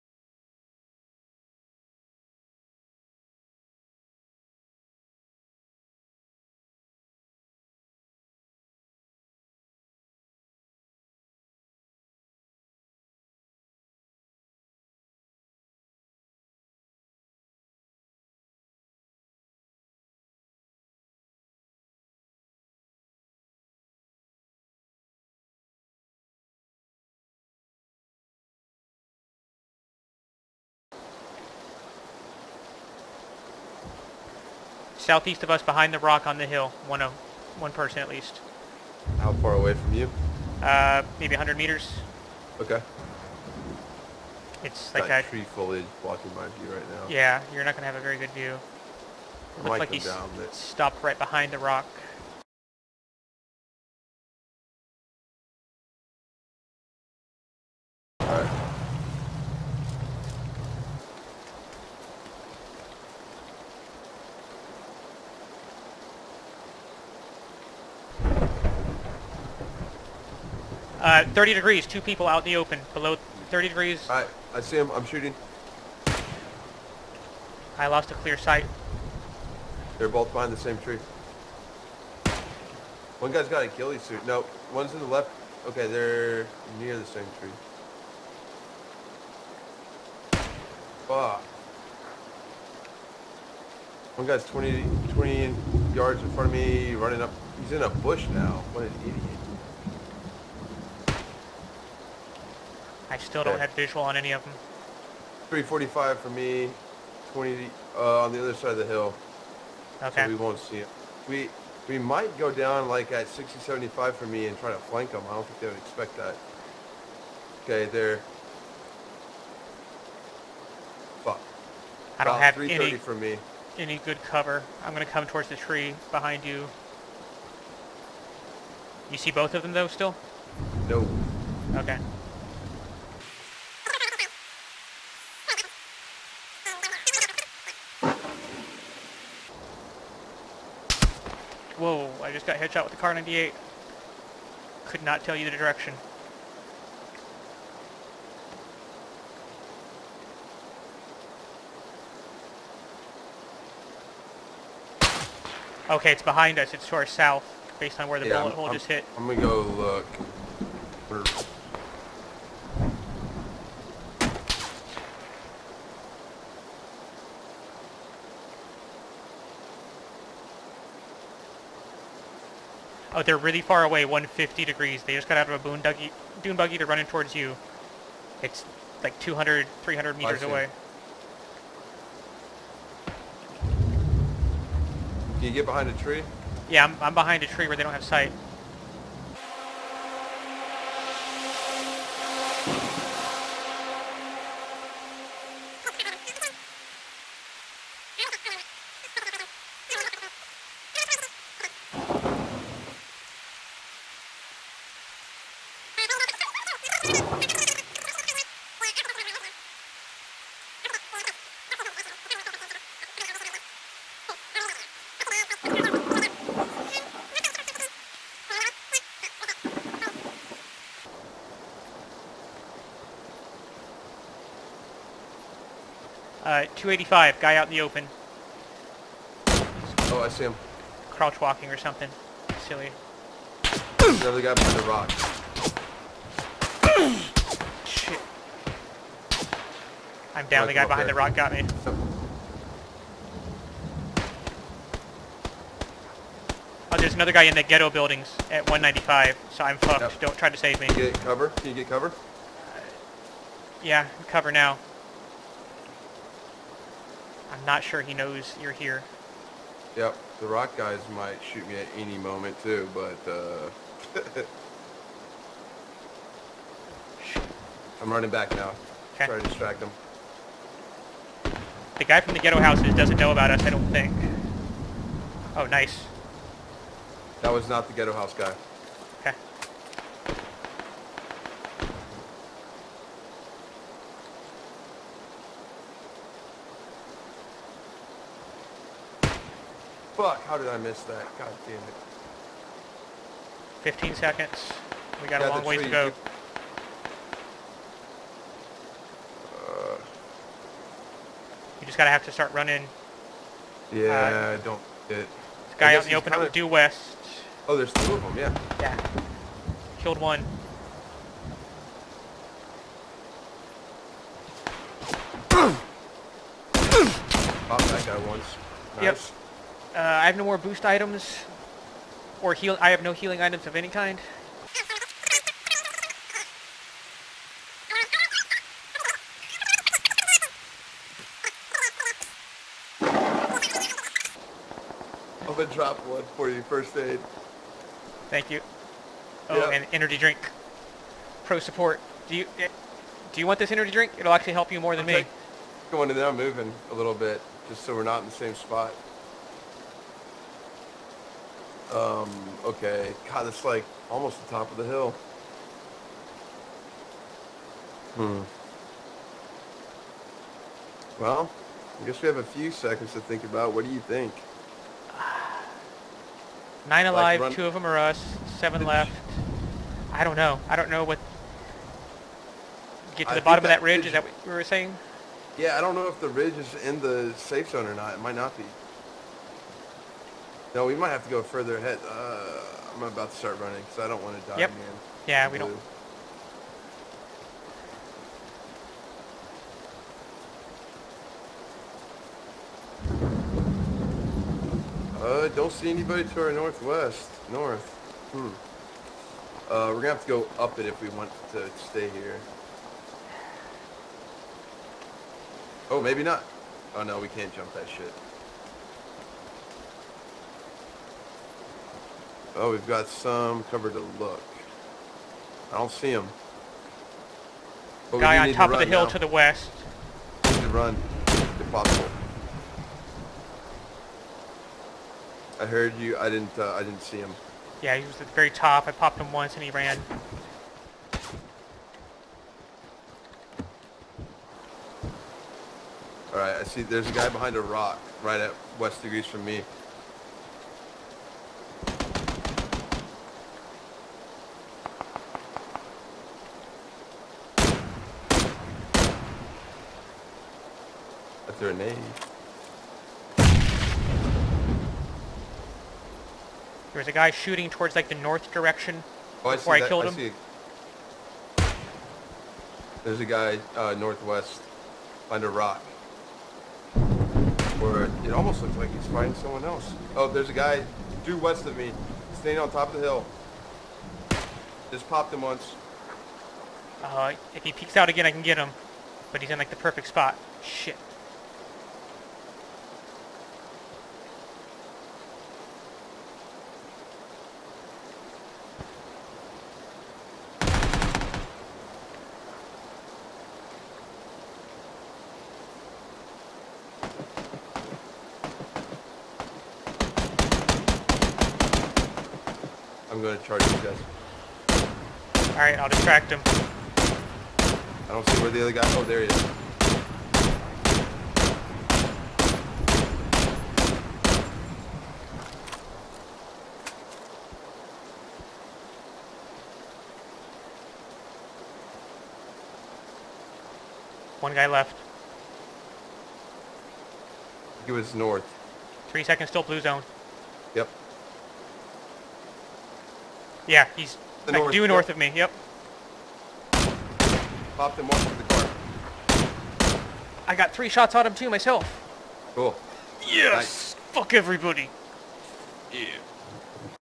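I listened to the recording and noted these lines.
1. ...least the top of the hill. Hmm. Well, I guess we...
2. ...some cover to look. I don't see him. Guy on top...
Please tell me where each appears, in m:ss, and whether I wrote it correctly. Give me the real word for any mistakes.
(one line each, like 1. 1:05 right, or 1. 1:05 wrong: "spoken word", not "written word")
1. 5:54 wrong: "almost", not "least"
2. 6:53 right.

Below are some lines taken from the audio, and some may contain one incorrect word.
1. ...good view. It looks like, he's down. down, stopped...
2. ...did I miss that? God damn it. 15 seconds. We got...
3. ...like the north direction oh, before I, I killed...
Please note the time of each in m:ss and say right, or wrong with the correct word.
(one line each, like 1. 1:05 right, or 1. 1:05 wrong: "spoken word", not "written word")
1. 0:48 right
2. 4:50 right
3. 7:37 right.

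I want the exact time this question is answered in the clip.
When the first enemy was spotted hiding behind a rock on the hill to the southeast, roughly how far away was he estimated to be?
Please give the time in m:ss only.
0:41.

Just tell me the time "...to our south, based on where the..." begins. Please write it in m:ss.
2:36.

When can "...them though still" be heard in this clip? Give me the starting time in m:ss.
2:09.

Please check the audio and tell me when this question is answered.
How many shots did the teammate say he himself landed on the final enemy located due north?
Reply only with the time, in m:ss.
9:00.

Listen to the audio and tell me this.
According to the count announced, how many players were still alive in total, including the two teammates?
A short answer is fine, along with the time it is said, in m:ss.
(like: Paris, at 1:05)
9, at 6:06.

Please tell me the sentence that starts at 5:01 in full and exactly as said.
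Just got to have to start running.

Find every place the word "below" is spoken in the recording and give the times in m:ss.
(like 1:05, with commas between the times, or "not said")
1:12.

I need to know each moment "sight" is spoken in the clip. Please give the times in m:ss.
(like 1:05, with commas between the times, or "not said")
1:18, 3:08.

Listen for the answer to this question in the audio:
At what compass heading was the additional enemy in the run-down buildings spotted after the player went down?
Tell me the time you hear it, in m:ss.
4:08.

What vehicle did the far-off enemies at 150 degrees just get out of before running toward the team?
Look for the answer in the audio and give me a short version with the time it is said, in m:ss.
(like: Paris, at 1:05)
dune buggy, at 2:56.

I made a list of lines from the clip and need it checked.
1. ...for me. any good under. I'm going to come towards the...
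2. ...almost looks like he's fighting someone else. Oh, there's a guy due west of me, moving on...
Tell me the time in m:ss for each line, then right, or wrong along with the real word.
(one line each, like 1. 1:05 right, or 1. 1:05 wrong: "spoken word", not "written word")
1. 2:02 wrong: "cover", not "under"
2. 7:48 wrong: "standing", not "moving".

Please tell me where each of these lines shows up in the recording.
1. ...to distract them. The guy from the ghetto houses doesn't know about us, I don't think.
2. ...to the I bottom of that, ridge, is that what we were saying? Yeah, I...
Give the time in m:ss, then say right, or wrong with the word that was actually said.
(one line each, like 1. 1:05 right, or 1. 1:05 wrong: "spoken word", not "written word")
1. 4:29 right
2. 6:13 right.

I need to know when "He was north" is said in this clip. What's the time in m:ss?
8:47.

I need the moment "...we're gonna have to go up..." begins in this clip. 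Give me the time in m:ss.
6:39.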